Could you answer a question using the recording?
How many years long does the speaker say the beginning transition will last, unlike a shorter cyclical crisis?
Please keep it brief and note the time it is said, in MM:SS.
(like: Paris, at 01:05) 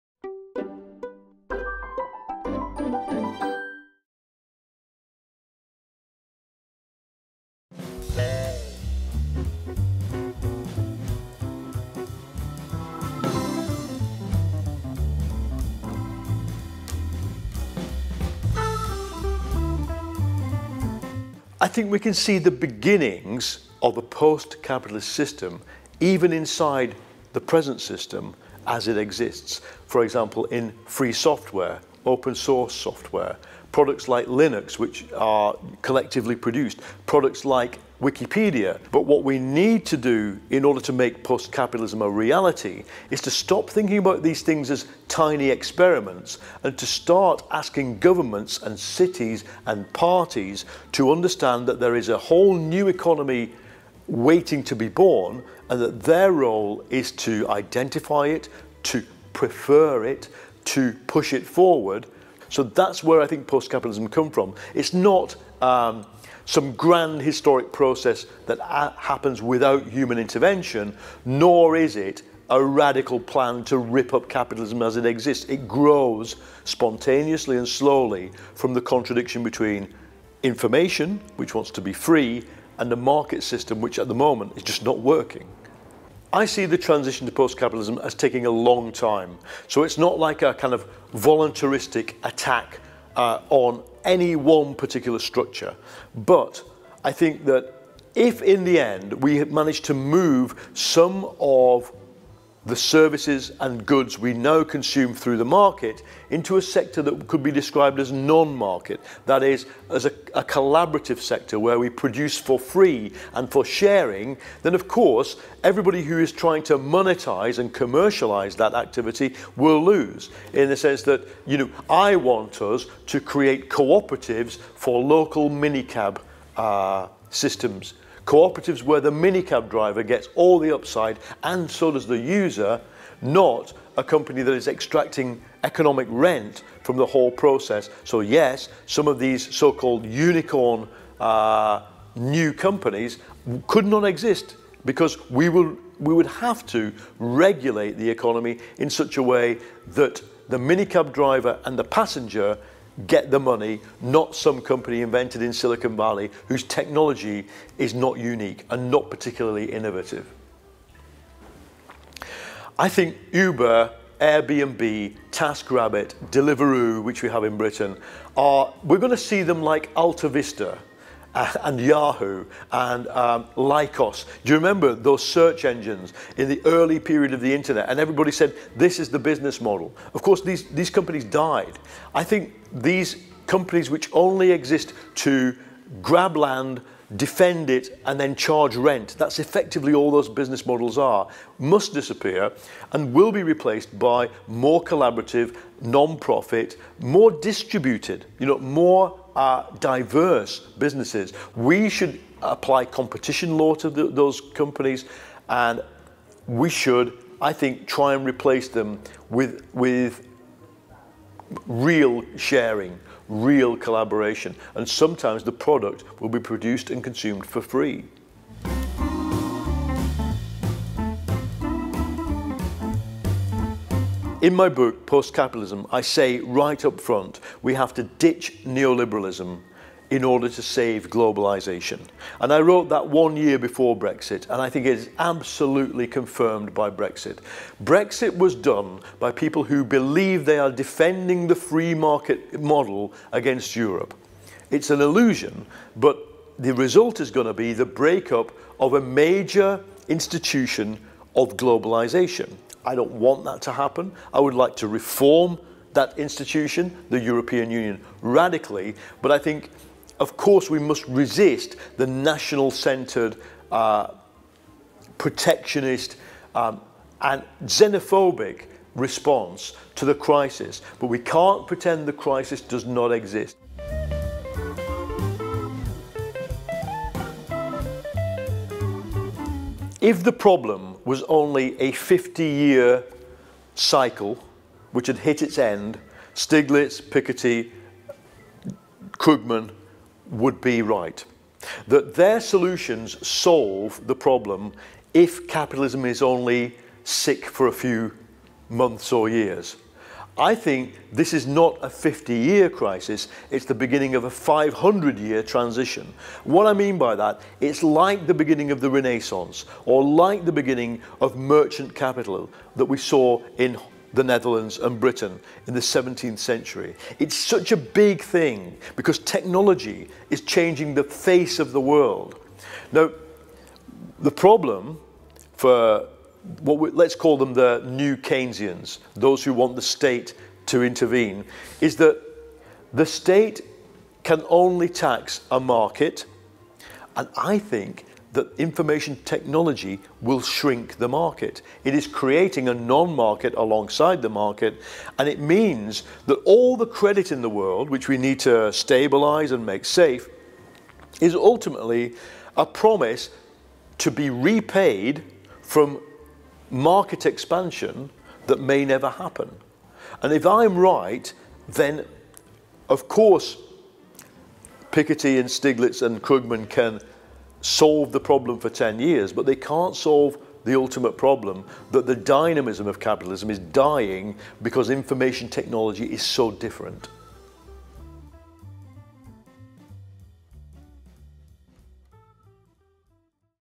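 500, at 05:04.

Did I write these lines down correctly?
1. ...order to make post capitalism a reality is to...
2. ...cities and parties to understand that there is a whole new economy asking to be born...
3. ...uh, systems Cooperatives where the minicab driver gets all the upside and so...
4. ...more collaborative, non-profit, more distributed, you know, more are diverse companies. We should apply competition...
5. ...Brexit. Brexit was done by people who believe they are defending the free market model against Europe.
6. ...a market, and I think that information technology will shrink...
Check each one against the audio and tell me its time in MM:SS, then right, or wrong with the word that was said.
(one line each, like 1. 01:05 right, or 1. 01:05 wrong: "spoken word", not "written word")
1. 00:40 right
2. 00:48 wrong: "waiting", not "asking"
3. 02:06 right
4. 03:14 wrong: "businesses", not "companies"
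5. 03:56 right
6. 05:35 right.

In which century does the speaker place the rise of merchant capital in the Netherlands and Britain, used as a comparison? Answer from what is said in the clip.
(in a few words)
17th century.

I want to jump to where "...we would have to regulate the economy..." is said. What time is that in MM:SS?
02:25.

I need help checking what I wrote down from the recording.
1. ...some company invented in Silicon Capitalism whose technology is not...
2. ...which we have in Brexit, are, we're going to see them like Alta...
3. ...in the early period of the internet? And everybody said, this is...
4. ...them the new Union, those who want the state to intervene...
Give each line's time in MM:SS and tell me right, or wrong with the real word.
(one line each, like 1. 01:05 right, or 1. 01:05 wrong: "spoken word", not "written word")
1. 02:34 wrong: "Valley", not "Capitalism"
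2. 02:47 wrong: "Britain", not "Brexit"
3. 02:56 right
4. 05:27 wrong: "Keynesians", not "Union".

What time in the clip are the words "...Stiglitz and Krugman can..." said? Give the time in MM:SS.
06:05.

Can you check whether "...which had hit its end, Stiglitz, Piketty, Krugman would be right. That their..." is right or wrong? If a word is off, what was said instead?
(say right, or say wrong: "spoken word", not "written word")
right.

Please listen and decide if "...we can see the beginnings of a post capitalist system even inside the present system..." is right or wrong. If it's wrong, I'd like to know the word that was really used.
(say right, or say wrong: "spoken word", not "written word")
right.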